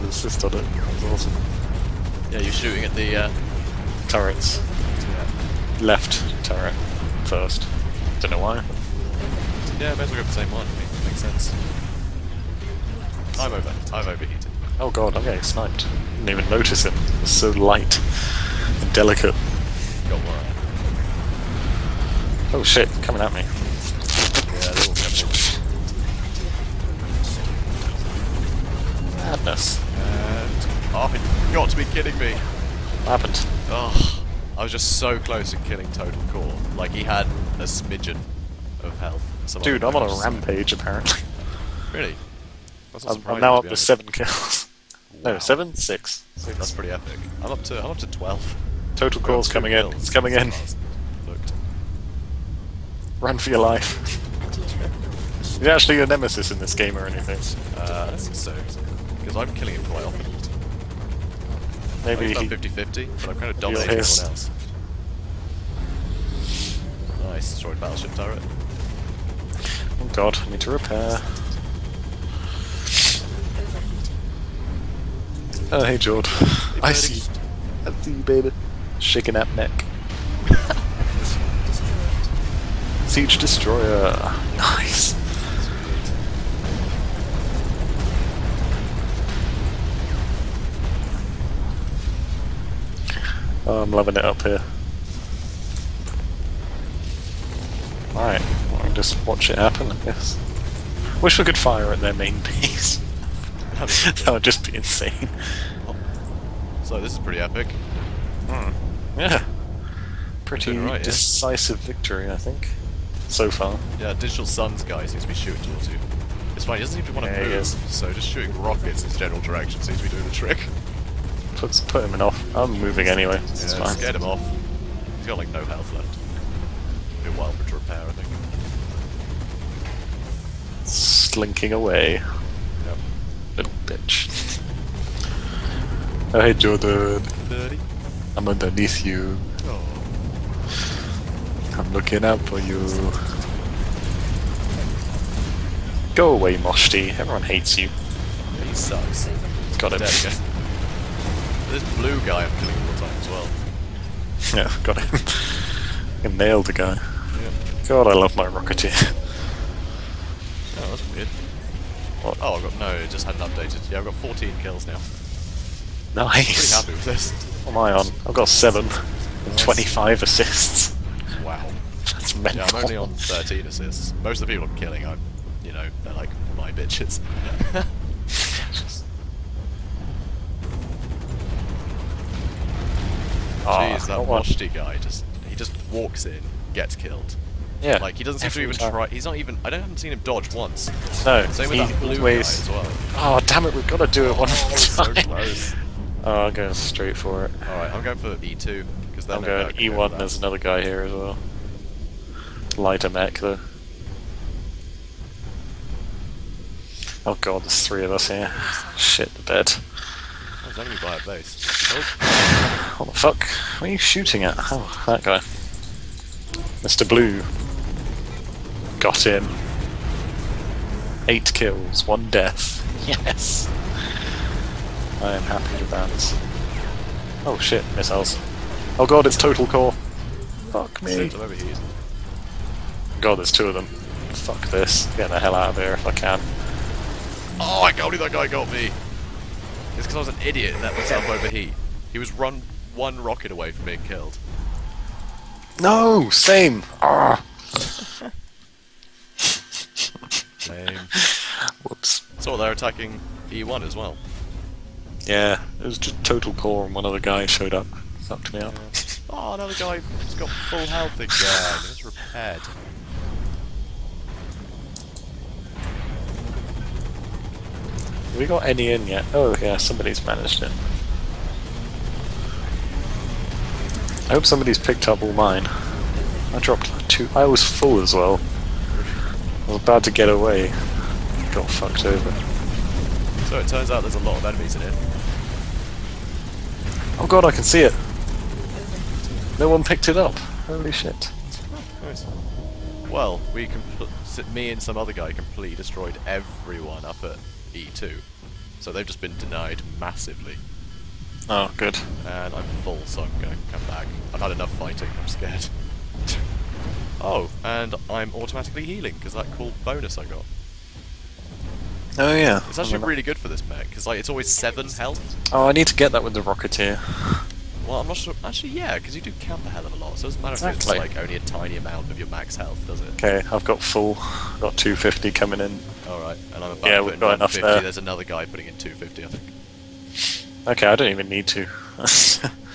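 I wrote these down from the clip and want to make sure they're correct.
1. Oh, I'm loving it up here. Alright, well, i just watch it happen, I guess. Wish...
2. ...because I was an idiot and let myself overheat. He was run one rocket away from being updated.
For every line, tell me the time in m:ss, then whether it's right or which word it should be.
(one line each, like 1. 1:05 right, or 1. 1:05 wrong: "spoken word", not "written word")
1. 1:33 right
2. 4:00 wrong: "killed", not "updated".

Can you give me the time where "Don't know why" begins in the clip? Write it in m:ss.
0:08.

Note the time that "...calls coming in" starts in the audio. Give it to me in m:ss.
0:49.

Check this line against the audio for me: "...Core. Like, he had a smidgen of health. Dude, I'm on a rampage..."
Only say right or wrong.
right.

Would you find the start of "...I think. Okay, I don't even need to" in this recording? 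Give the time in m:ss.
5:29.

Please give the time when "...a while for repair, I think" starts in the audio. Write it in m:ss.
2:07.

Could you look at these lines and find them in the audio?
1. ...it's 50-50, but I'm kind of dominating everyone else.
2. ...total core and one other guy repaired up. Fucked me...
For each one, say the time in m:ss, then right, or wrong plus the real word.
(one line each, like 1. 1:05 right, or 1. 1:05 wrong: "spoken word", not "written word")
1. 1:02 right
2. 4:16 wrong: "showed", not "repaired".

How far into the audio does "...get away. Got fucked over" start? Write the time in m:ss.
4:40.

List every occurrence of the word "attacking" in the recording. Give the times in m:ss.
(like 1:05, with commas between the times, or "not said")
4:12.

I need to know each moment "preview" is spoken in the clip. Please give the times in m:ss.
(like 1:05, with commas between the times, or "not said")
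not said.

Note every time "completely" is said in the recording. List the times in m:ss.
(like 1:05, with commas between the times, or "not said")
4:55.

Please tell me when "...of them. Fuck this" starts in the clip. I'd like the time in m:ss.
3:53.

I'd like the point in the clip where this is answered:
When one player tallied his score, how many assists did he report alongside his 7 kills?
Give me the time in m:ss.
2:49.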